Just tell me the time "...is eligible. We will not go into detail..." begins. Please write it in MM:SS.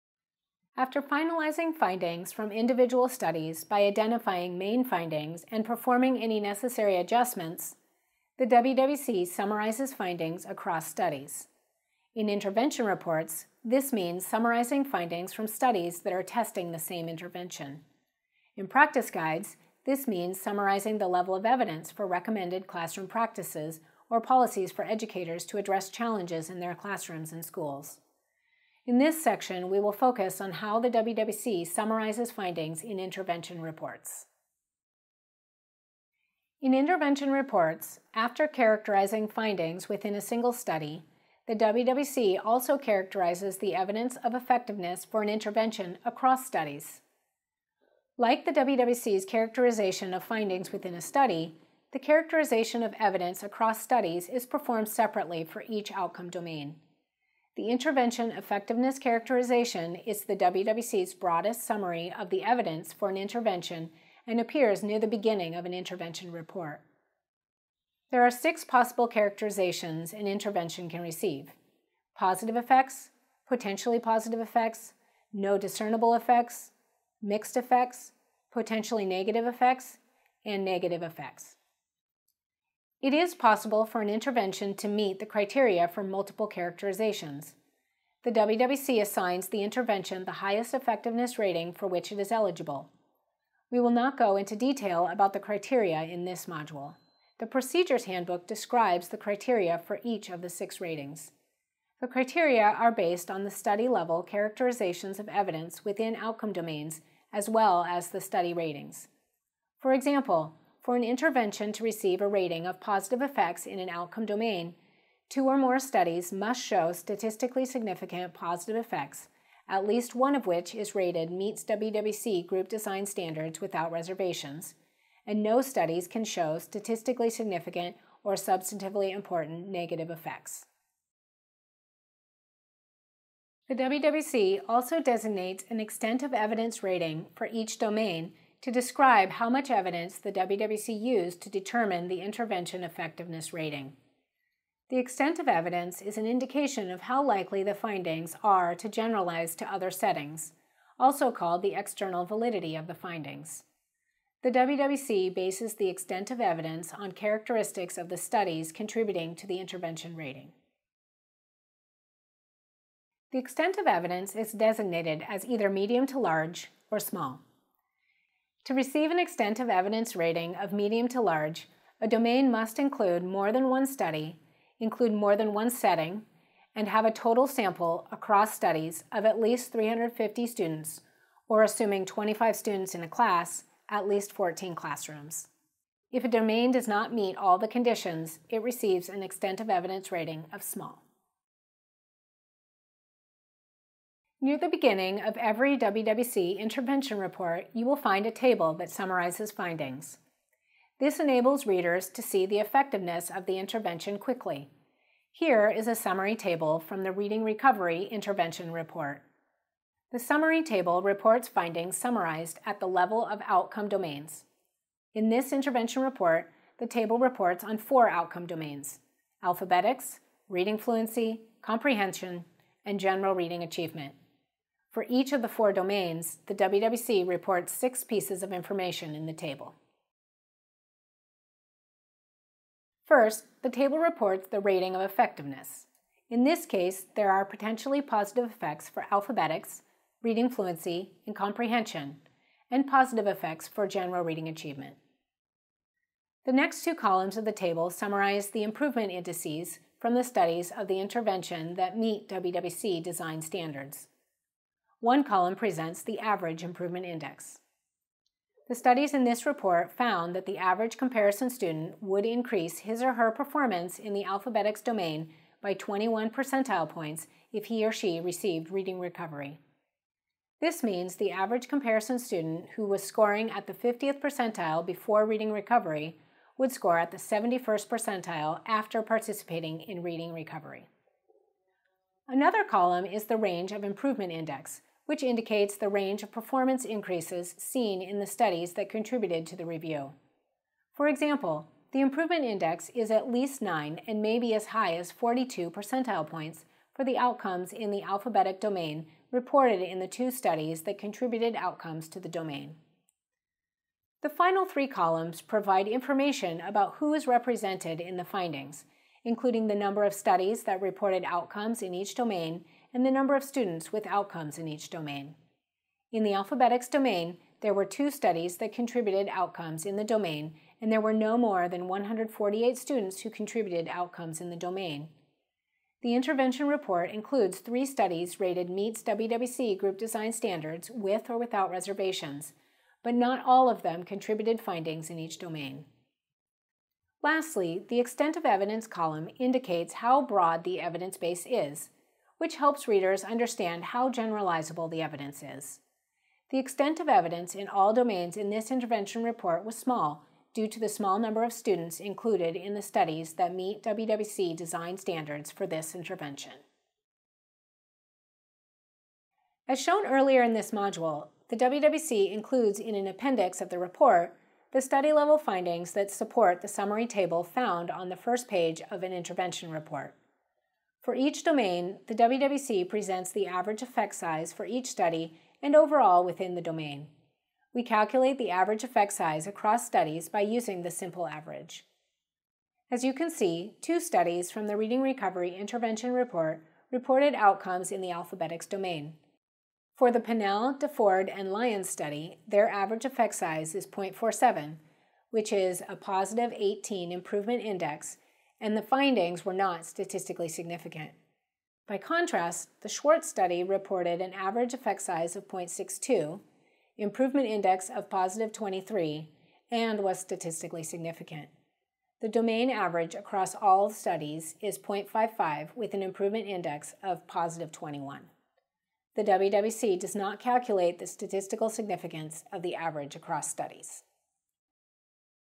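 01:32.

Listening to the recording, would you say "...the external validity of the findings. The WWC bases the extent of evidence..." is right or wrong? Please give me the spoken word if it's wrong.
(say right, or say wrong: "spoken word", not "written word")
right.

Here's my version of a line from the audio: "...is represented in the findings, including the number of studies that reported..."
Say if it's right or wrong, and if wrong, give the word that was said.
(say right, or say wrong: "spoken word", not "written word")
right.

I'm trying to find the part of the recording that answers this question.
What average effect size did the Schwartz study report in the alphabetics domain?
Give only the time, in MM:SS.
06:45.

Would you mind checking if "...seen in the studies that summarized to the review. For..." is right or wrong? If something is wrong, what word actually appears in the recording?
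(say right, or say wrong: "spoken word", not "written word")
wrong: "contributed", not "summarized".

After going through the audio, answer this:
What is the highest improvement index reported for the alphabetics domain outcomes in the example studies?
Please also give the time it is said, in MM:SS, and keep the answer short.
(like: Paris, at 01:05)
42, at 04:55.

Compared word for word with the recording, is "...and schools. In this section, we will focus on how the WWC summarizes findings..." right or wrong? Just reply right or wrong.
right.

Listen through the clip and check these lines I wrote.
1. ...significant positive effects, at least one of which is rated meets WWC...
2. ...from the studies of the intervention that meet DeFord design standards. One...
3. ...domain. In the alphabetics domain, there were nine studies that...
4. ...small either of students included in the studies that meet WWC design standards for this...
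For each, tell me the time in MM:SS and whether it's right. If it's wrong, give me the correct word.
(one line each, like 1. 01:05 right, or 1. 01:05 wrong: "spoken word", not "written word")
1. 01:57 right
2. 04:09 wrong: "WWC", not "DeFord"
3. 05:14 wrong: "two", not "nine"
4. 05:50 wrong: "number", not "either".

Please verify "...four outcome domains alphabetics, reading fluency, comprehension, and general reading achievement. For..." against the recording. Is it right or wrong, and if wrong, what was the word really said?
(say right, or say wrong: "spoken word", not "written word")
right.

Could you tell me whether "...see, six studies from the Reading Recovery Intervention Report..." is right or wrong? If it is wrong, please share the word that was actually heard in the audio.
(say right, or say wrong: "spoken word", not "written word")
wrong: "two", not "six".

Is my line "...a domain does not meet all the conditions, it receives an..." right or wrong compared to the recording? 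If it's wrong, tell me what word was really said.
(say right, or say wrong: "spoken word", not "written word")
right.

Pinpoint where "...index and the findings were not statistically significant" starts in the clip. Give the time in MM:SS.
06:37.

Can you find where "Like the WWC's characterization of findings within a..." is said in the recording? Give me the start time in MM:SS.
00:48.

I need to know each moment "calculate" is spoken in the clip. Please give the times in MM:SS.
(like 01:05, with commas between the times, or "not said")
06:17, 07:00.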